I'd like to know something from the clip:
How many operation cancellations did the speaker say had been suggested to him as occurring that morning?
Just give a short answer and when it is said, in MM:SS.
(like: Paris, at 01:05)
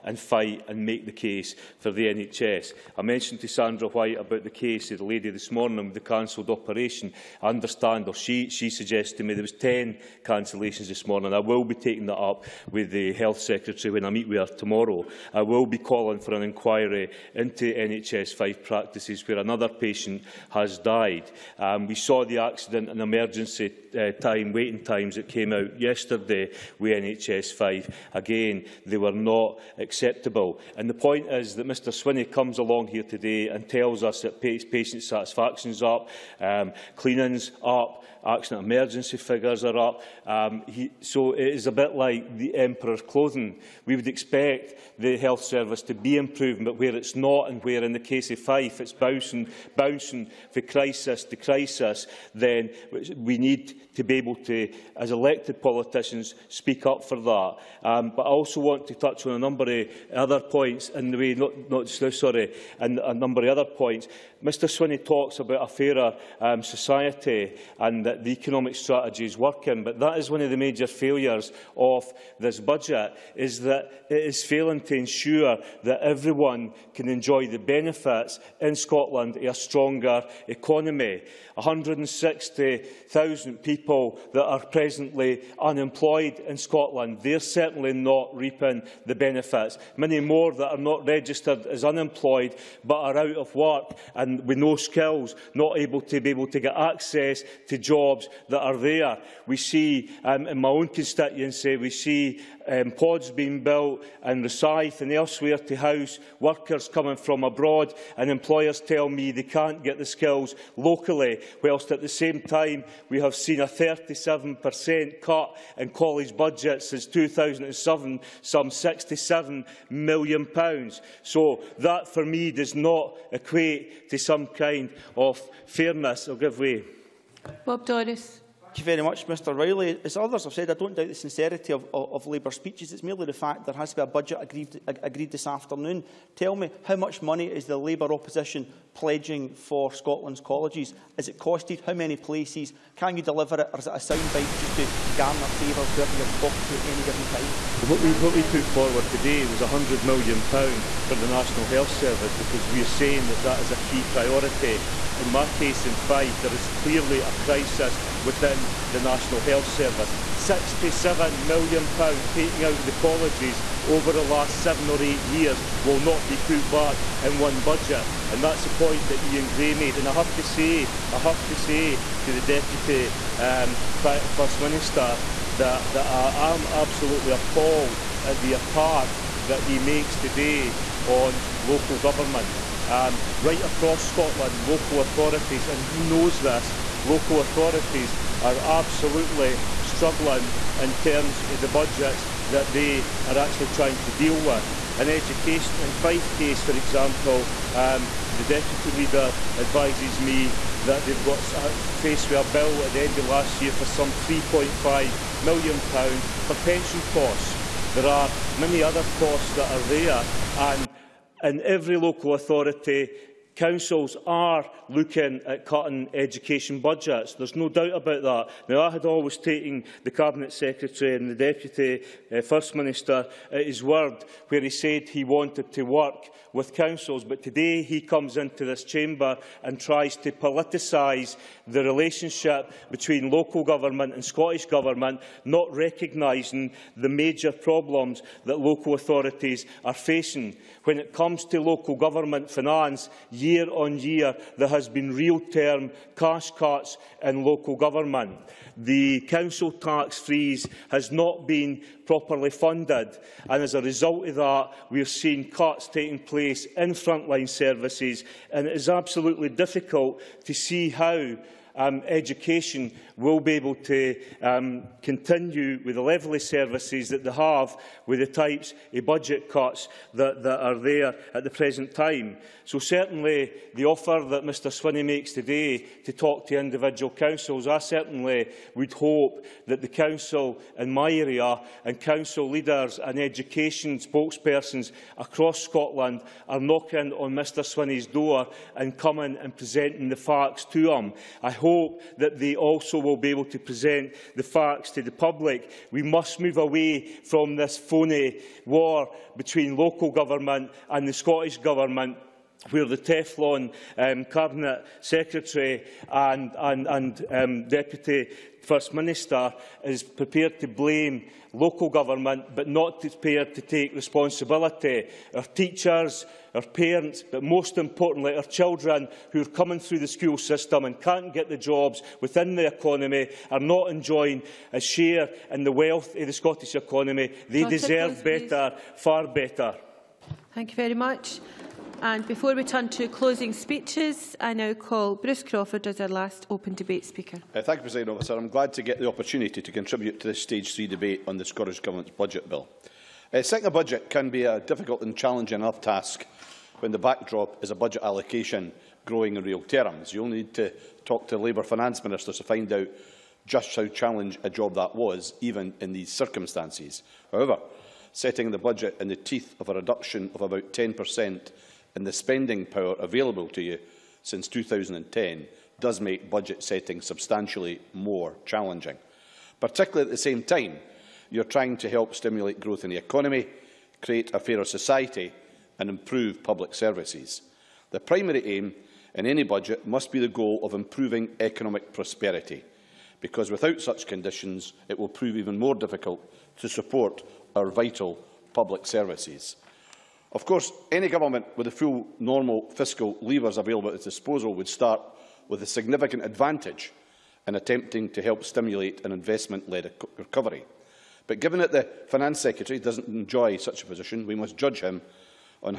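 10, at 00:09.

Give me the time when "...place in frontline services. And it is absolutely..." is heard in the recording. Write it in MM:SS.
04:16.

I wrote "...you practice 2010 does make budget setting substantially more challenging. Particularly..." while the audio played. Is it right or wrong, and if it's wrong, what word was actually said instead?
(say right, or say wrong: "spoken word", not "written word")
wrong: "since", not "practice".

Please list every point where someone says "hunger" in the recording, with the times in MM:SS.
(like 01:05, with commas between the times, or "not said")
not said.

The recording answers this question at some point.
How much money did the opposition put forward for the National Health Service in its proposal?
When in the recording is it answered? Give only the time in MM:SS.
02:29.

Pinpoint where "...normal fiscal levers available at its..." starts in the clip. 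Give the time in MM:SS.
06:32.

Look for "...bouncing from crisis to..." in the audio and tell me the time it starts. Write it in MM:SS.
00:49.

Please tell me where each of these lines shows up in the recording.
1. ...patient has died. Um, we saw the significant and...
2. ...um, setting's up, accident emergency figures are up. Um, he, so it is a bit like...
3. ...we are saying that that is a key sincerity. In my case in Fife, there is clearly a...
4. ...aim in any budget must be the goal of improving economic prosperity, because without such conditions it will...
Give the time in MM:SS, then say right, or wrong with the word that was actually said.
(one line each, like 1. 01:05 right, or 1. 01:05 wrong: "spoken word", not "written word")
1. 00:19 wrong: "accident", not "significant"
2. 00:36 wrong: "cleaning", not "setting"
3. 02:32 wrong: "priority", not "sincerity"
4. 06:18 right.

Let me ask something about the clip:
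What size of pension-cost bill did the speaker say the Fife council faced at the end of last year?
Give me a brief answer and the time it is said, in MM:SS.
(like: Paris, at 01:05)
£3.5 million, at 03:24.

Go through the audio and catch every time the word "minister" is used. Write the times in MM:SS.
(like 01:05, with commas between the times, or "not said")
02:54, 03:42, 05:08, 05:52.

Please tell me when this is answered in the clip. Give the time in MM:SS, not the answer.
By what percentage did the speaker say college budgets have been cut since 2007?
01:53.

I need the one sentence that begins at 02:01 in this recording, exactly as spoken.
So that for me does not equate to some kind of fairness.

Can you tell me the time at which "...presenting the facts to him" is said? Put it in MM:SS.
04:49.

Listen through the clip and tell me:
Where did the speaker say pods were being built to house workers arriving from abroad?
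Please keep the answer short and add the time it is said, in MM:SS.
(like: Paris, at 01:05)
Rosyth, at 01:44.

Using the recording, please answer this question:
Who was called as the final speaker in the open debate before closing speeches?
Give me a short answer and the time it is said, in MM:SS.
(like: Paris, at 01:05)
Bruce Crawford, at 05:35.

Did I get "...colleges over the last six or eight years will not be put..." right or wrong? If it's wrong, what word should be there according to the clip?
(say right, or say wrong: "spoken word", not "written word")
wrong: "seven", not "six".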